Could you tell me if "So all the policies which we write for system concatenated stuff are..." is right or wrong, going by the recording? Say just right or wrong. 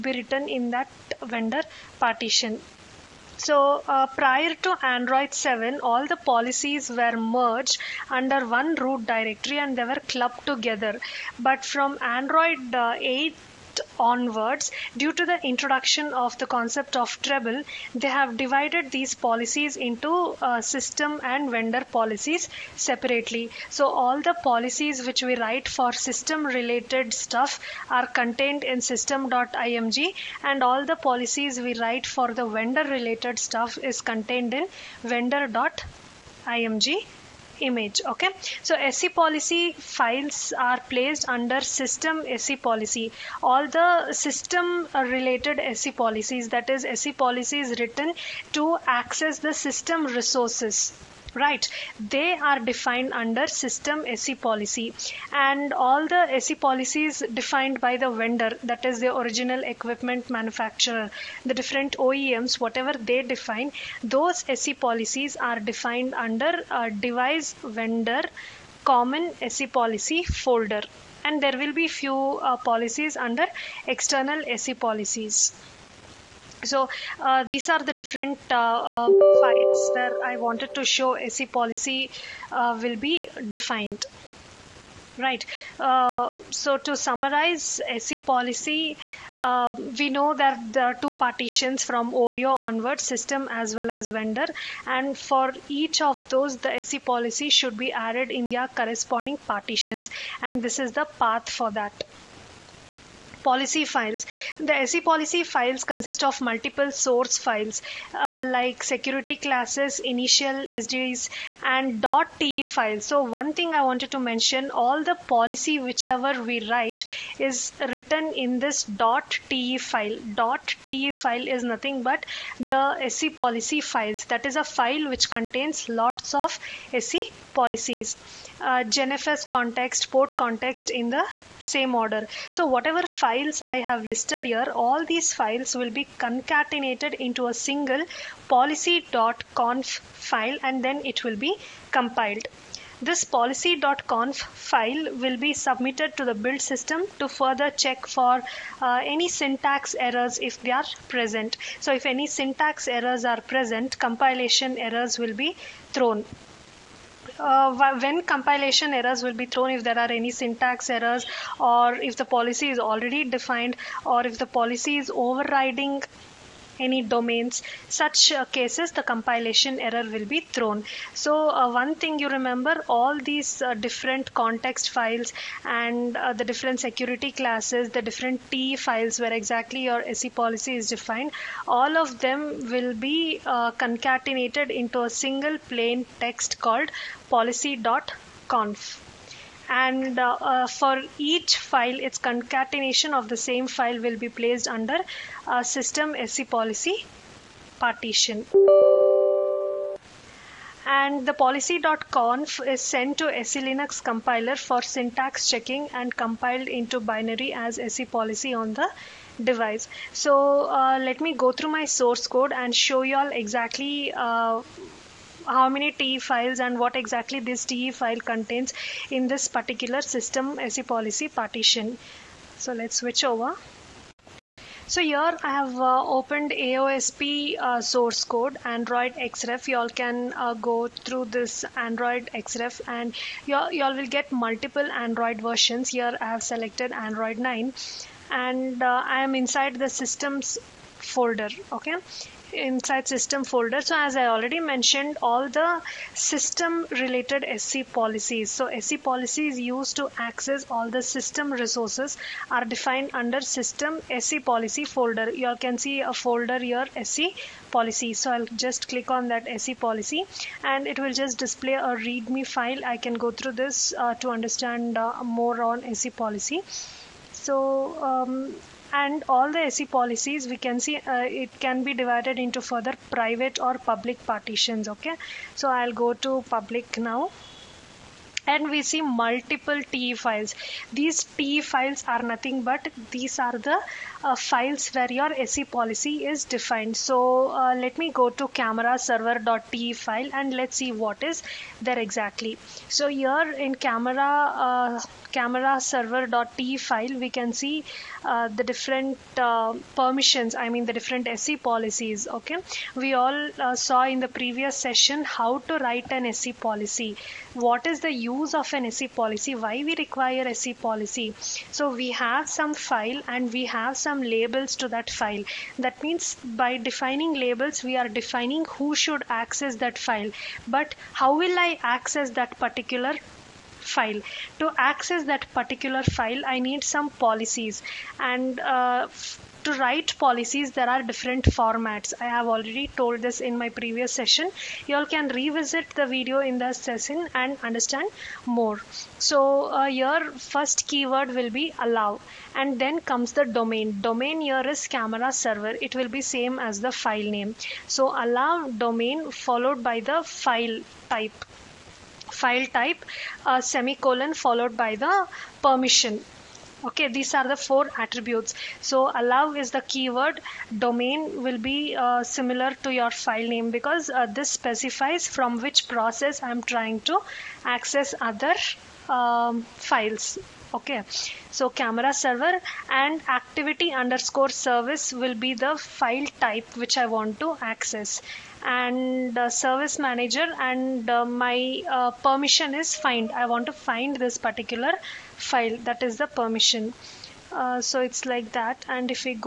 wrong.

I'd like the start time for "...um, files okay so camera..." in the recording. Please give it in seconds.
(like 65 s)
369 s.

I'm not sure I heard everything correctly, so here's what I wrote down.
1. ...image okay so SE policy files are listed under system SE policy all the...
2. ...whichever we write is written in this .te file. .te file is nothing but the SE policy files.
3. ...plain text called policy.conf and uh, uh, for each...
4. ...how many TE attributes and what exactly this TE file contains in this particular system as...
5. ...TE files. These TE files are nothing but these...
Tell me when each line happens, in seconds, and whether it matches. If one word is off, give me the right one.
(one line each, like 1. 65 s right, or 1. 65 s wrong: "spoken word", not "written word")
1. 37 s wrong: "placed", not "listed"
2. 115 s right
3. 185 s right
4. 215 s wrong: "files", not "attributes"
5. 279 s right.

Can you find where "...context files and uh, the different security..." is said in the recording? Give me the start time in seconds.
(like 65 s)
174 s.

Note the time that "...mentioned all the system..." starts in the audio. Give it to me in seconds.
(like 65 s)
244 s.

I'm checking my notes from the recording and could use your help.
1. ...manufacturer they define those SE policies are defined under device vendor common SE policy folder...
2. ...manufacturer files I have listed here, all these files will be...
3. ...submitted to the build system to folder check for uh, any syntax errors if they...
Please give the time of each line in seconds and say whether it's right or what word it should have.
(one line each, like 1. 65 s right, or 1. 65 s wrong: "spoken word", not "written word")
1. 62 s wrong: "whatever", not "manufacturer"
2. 132 s wrong: "whatever", not "manufacturer"
3. 145 s wrong: "further", not "folder".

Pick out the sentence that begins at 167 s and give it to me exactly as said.
Such uh, cases, the compilation error will be thrown.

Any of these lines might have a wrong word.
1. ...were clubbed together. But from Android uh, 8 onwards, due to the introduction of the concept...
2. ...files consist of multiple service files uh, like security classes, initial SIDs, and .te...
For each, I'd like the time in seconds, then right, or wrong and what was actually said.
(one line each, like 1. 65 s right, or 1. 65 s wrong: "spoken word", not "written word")
1. 9 s right
2. 105 s wrong: "source", not "service".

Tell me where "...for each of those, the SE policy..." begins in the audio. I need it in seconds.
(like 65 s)
95 s.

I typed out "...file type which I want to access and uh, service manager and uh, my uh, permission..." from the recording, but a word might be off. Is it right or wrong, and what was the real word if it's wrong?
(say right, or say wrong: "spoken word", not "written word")
right.